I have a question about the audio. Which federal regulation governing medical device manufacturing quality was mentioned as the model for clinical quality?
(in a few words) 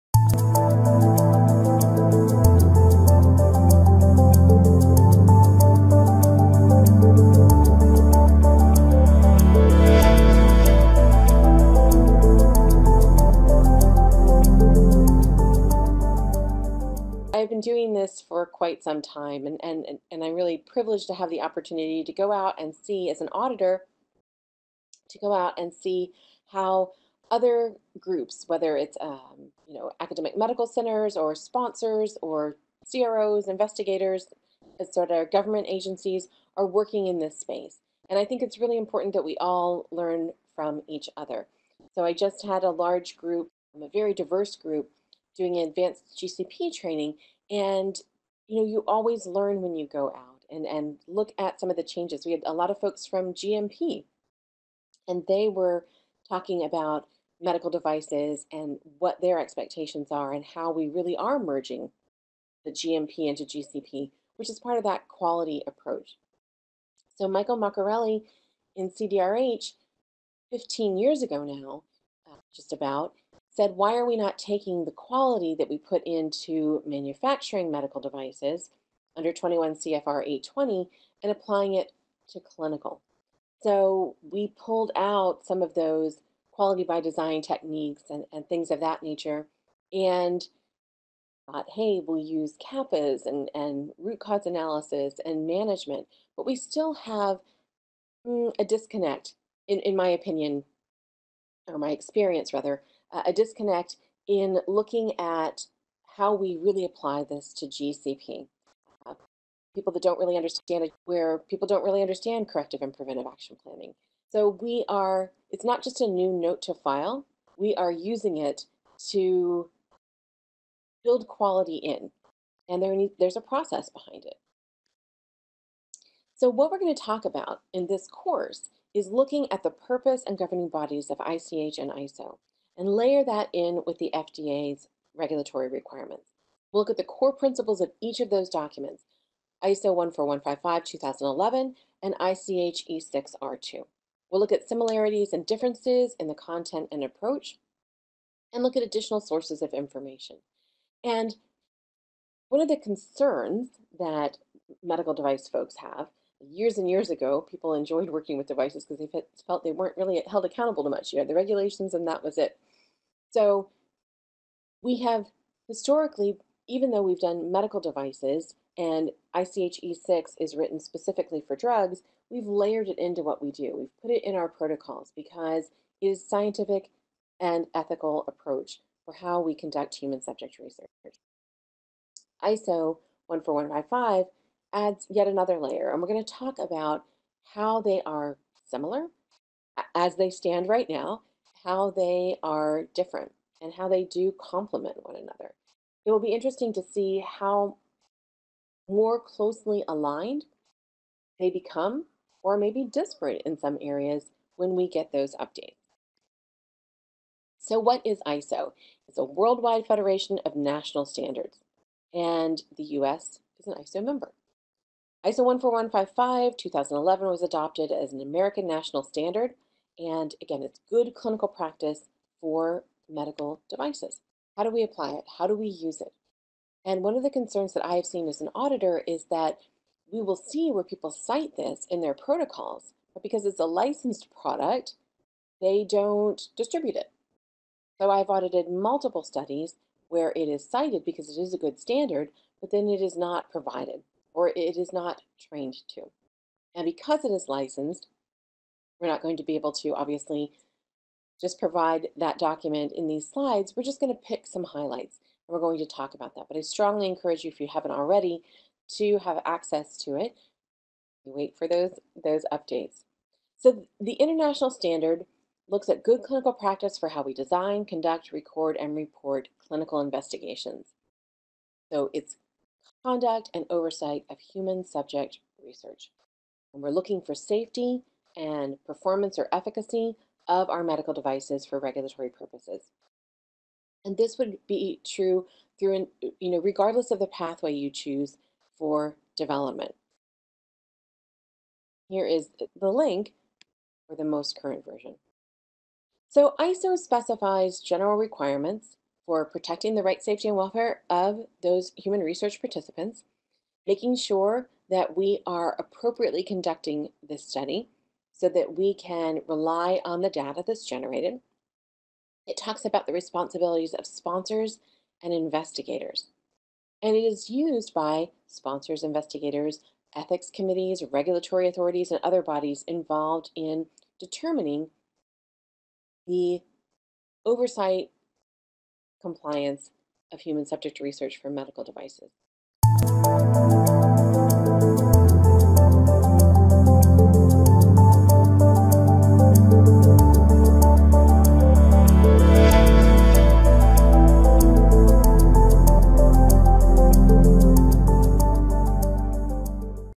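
21 CFR 820.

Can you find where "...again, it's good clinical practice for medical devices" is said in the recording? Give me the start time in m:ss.
3:40.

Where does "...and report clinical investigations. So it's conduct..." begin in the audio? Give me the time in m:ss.
4:28.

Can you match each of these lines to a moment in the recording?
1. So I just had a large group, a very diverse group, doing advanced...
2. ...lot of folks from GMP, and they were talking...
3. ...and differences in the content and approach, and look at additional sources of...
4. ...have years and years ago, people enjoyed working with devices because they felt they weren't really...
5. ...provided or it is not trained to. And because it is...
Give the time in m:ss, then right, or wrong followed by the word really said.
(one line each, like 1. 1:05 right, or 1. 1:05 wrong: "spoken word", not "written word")
1. 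0:41 right
2. 0:52 right
3. 2:25 right
4. 2:35 right
5. 4:03 right.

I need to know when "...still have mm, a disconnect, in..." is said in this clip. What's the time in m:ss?
1:36.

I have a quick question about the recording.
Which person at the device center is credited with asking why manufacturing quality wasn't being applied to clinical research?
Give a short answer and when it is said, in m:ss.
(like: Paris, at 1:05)
Michael Marcarelli, at 1:07.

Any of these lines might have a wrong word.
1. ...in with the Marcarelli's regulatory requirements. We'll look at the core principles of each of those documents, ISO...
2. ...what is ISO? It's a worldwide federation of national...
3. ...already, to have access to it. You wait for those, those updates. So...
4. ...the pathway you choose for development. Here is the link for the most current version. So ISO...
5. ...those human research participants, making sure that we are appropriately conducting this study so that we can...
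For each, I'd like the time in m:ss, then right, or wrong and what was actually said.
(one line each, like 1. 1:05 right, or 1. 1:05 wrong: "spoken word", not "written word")
1. 2:13 wrong: "FDA", not "Marcarelli"
2. 3:27 right
3. 4:17 right
4. 4:47 right
5. 5:01 right.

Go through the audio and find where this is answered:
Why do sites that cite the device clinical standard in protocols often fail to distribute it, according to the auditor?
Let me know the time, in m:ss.
3:53.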